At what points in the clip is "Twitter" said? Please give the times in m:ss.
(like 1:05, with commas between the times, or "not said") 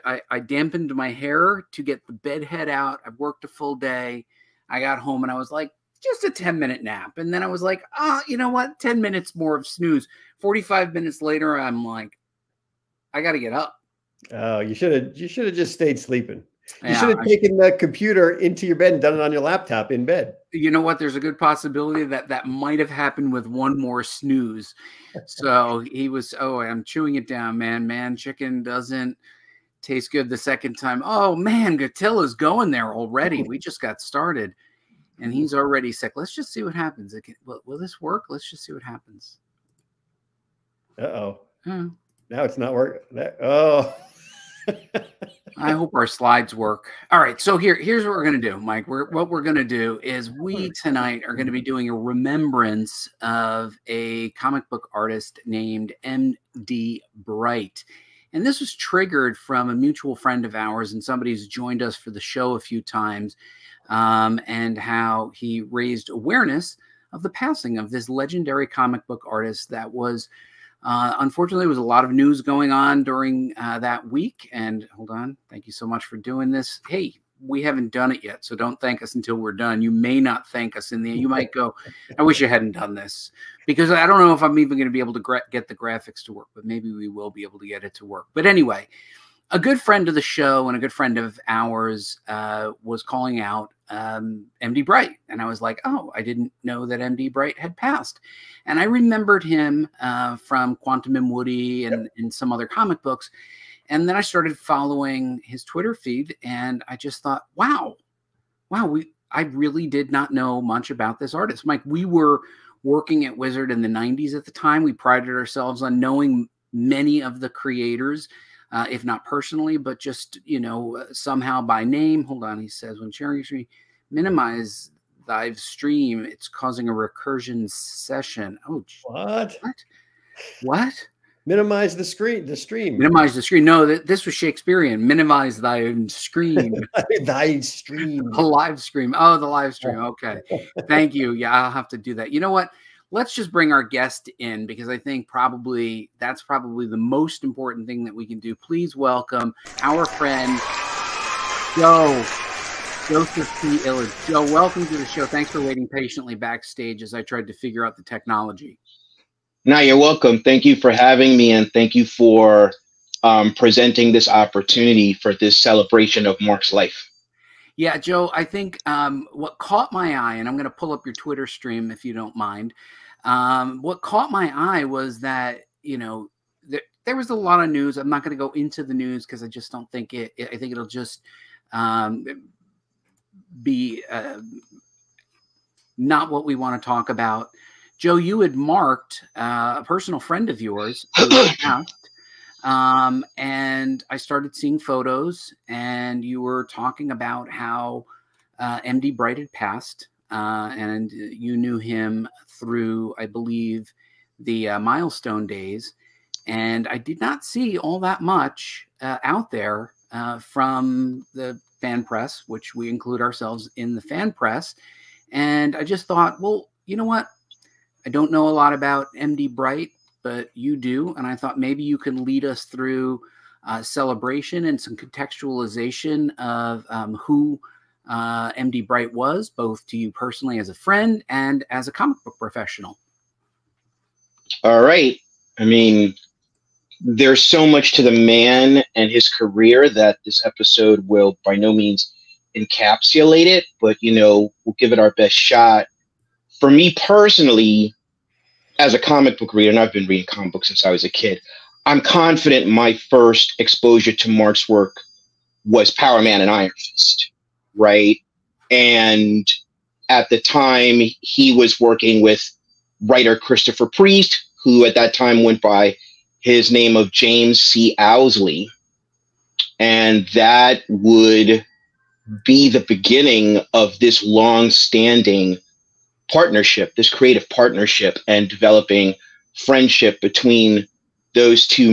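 1:45, 2:51.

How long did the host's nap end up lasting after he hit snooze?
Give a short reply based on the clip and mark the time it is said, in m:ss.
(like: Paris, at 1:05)
45 minutes, at 0:10.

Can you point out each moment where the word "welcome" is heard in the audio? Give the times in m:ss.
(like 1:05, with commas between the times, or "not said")
2:28, 2:34, 2:39.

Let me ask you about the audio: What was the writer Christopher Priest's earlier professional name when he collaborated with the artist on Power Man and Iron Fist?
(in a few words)
James C. Owsley.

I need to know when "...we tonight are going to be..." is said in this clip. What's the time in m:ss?
0:50.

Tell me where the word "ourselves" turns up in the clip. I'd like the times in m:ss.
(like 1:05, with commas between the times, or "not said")
1:55, 3:33.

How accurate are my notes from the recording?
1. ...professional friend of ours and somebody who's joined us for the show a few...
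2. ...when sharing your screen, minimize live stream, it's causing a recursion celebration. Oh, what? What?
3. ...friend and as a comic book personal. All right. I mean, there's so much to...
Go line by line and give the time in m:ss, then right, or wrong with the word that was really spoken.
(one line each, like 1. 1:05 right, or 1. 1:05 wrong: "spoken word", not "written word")
1. 0:59 wrong: "mutual", not "professional"
2. 2:02 wrong: "session", not "celebration"
3. 3:50 wrong: "professional", not "personal".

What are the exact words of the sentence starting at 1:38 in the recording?
And I remembered him uh, from Quantum and Woody and, yep.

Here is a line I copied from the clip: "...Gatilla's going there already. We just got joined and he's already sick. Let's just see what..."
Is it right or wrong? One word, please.
wrong.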